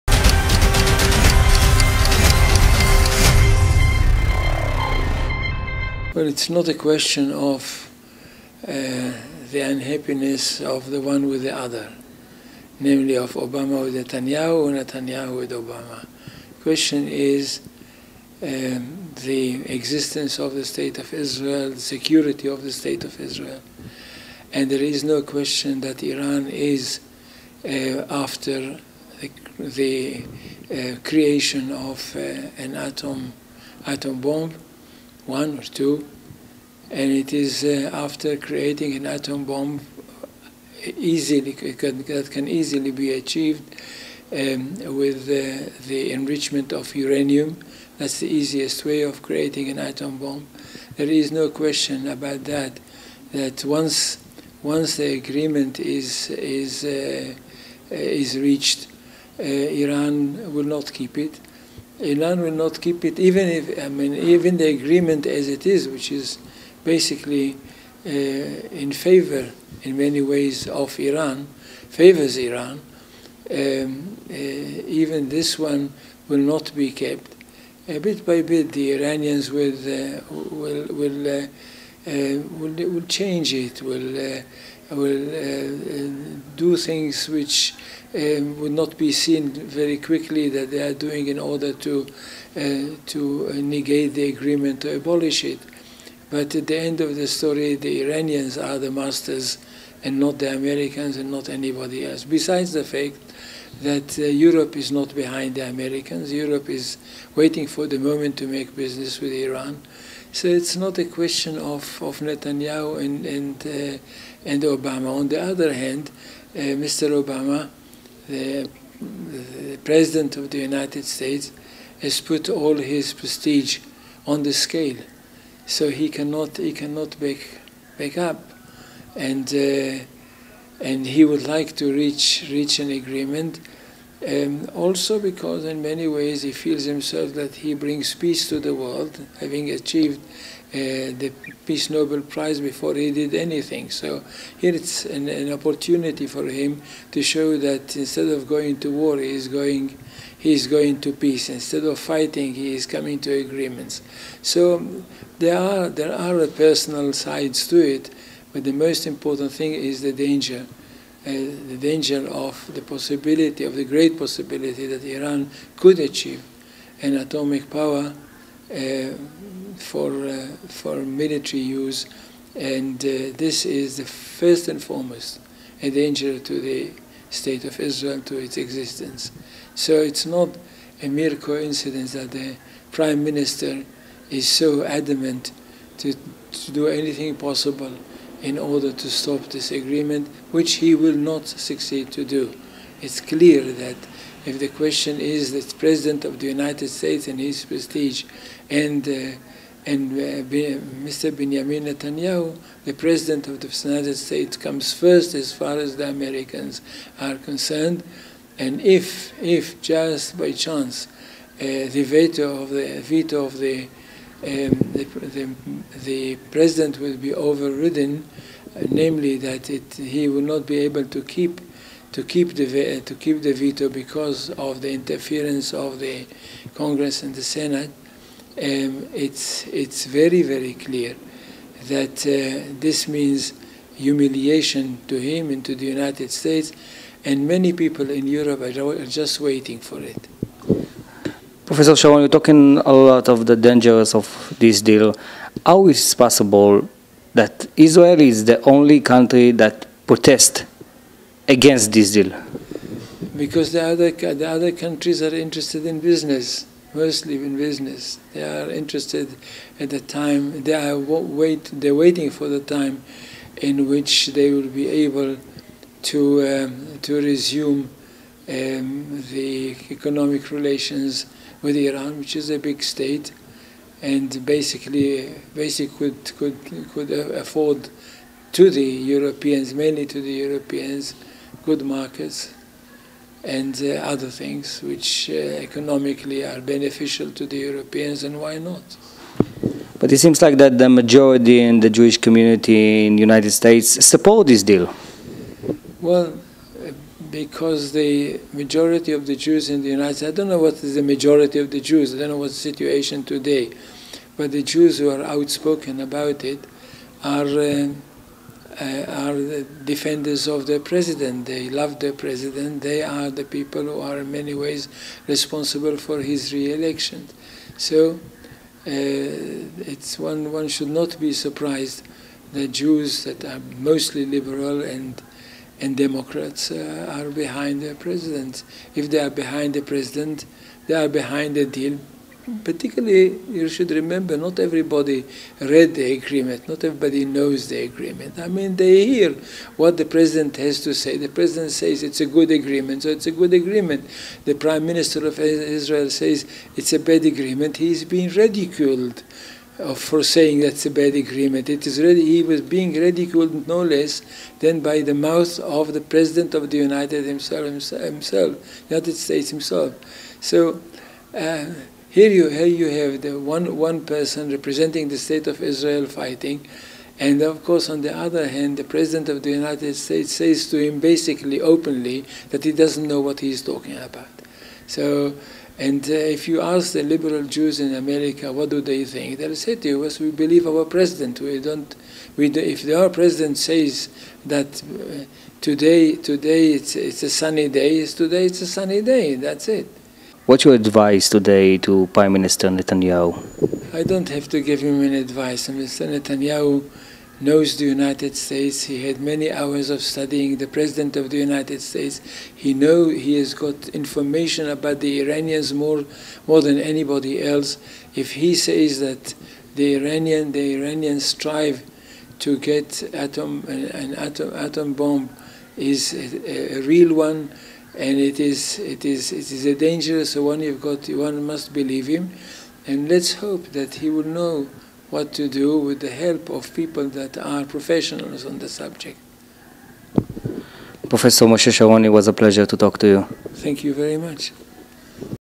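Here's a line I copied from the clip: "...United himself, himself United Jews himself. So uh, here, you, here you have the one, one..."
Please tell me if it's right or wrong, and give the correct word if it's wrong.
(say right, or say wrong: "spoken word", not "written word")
wrong: "States", not "Jews".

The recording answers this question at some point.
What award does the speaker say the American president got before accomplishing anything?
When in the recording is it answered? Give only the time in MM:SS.
02:21.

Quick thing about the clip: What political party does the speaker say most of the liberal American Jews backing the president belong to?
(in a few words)
Democrats.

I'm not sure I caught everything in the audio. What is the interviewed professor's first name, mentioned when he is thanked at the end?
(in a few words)
Moshe.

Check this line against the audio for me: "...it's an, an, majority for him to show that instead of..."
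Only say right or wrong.
wrong.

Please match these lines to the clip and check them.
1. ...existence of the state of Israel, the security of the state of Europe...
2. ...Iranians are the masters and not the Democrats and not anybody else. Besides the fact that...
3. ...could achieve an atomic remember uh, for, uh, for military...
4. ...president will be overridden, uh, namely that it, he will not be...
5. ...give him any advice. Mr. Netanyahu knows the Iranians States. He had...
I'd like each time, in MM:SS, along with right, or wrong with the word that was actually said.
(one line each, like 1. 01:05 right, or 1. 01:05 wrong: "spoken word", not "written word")
1. 00:19 wrong: "Israel", not "Europe"
2. 01:38 wrong: "Americans", not "Democrats"
3. 02:45 wrong: "power", not "remember"
4. 03:36 right
5. 06:34 wrong: "United", not "Iranians".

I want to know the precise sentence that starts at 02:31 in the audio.
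Instead of fighting, he is coming to agreements.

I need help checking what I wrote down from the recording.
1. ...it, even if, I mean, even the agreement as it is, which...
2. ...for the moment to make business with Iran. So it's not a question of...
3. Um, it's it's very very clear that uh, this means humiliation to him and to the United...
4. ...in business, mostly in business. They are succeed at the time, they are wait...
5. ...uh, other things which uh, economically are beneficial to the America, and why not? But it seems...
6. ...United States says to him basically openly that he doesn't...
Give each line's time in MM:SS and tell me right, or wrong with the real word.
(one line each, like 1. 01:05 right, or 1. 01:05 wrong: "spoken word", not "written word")
1. 01:03 right
2. 01:47 right
3. 03:48 right
4. 04:15 wrong: "interested", not "succeed"
5. 04:43 wrong: "Europeans", not "America"
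6. 06:09 right.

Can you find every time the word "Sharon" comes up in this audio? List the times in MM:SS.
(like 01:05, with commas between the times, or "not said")
04:01, 07:11.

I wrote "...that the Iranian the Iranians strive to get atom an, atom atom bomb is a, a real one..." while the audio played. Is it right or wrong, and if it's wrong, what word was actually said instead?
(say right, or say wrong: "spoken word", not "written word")
right.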